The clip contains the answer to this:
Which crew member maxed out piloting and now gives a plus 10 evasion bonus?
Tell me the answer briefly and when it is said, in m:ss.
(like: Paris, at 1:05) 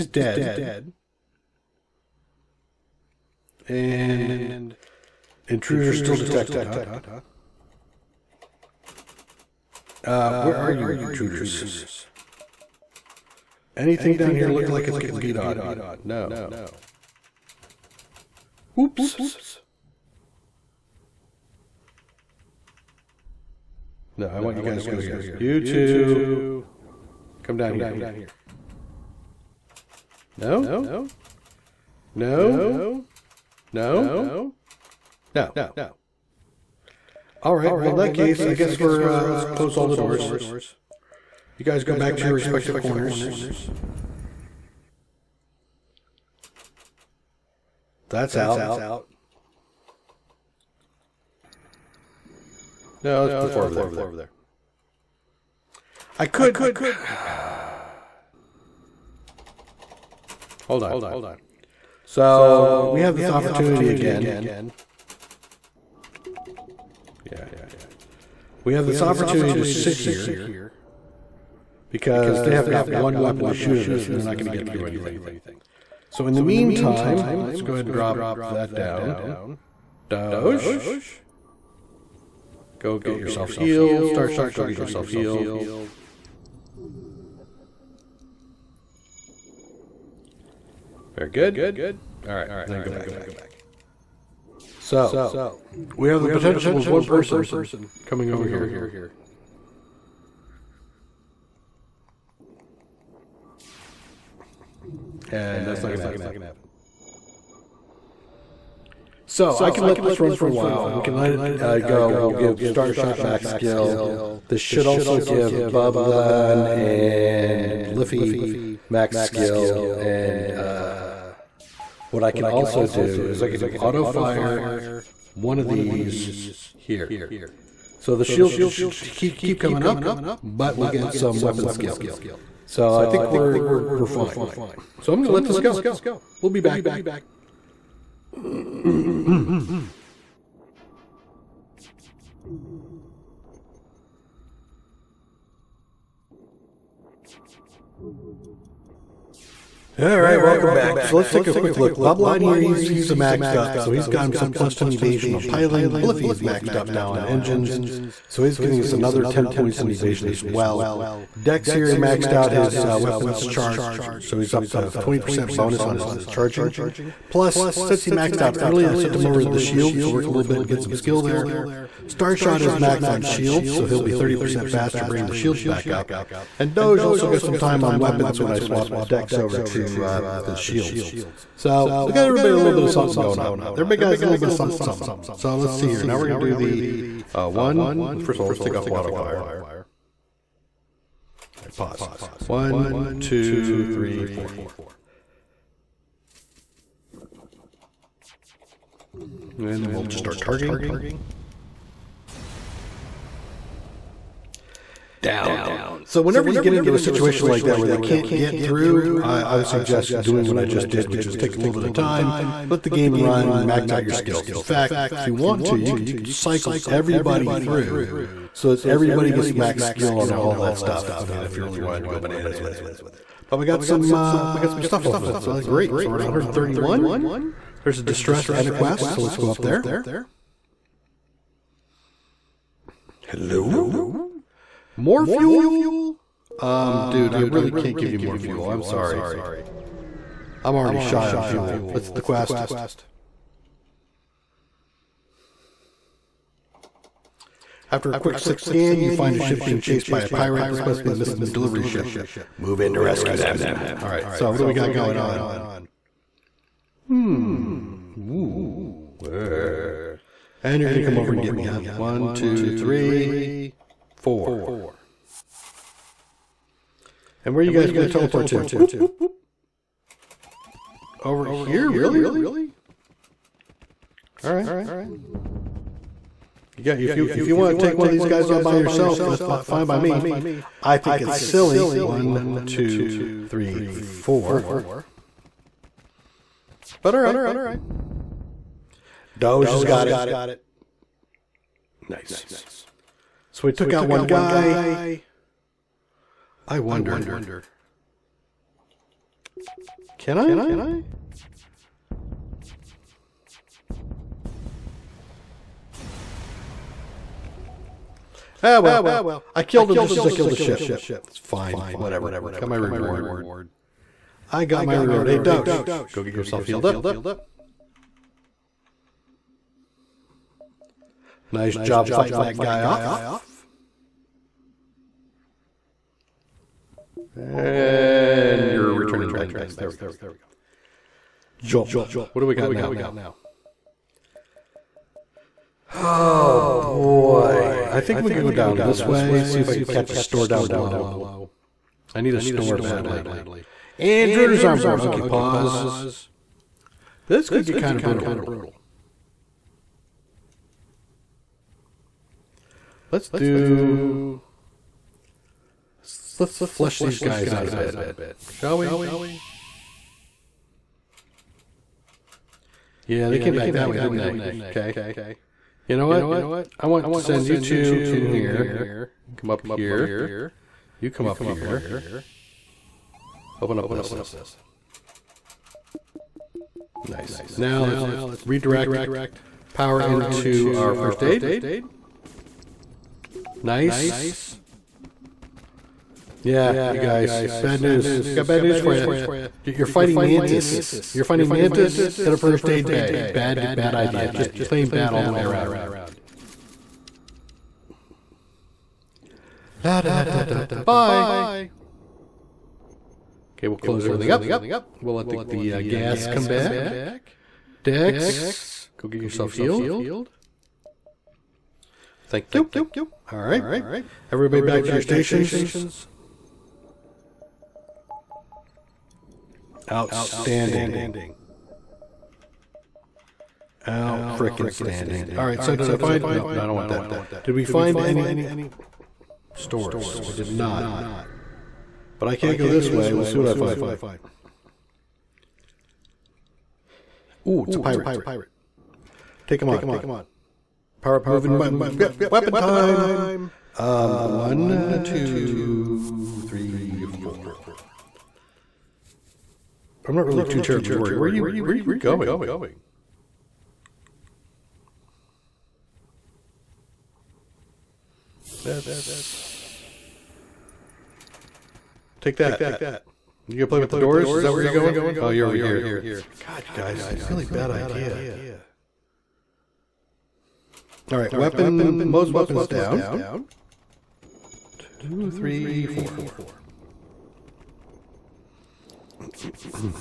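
Bubline, at 2:31.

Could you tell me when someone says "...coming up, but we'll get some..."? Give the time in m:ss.
2:09.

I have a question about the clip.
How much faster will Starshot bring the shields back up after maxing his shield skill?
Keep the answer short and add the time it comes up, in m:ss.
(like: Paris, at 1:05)
30%, at 2:54.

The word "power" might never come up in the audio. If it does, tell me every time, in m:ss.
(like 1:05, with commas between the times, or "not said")
6:19, 7:21.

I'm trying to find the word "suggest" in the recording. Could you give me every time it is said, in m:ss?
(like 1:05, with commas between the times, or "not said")
3:29.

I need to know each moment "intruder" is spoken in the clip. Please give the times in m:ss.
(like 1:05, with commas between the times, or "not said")
0:05, 0:11, 5:44.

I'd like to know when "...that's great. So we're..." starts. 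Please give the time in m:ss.
3:45.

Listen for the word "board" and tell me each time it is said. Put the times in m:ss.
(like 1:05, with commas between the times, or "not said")
5:44.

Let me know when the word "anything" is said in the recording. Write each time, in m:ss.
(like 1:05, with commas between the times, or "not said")
0:13, 1:14.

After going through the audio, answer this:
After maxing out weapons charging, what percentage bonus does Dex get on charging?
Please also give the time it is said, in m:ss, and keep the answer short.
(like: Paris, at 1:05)
20%, at 2:44.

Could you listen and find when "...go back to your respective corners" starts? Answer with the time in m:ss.
0:41.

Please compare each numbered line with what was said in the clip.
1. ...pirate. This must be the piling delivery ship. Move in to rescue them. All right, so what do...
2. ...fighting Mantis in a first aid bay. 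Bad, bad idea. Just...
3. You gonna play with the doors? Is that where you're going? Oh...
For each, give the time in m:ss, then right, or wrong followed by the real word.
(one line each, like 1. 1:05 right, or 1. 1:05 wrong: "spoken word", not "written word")
1. 4:10 wrong: "missing", not "piling"
2. 6:31 right
3. 7:43 right.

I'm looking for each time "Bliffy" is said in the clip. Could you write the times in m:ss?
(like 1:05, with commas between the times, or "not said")
1:57, 2:35.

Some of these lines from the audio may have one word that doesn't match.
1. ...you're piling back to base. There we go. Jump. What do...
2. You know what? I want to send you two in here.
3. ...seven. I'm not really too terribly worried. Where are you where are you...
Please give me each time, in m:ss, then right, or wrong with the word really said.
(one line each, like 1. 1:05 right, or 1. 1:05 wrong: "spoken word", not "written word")
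1. 5:28 wrong: "returning", not "piling"
2. 6:05 right
3. 7:27 wrong: "four", not "seven".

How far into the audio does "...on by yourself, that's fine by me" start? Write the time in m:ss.
4:38.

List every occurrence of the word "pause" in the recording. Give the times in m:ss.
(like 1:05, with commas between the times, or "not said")
3:11, 5:45.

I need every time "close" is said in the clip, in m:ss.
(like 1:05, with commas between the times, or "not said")
0:39, 6:43.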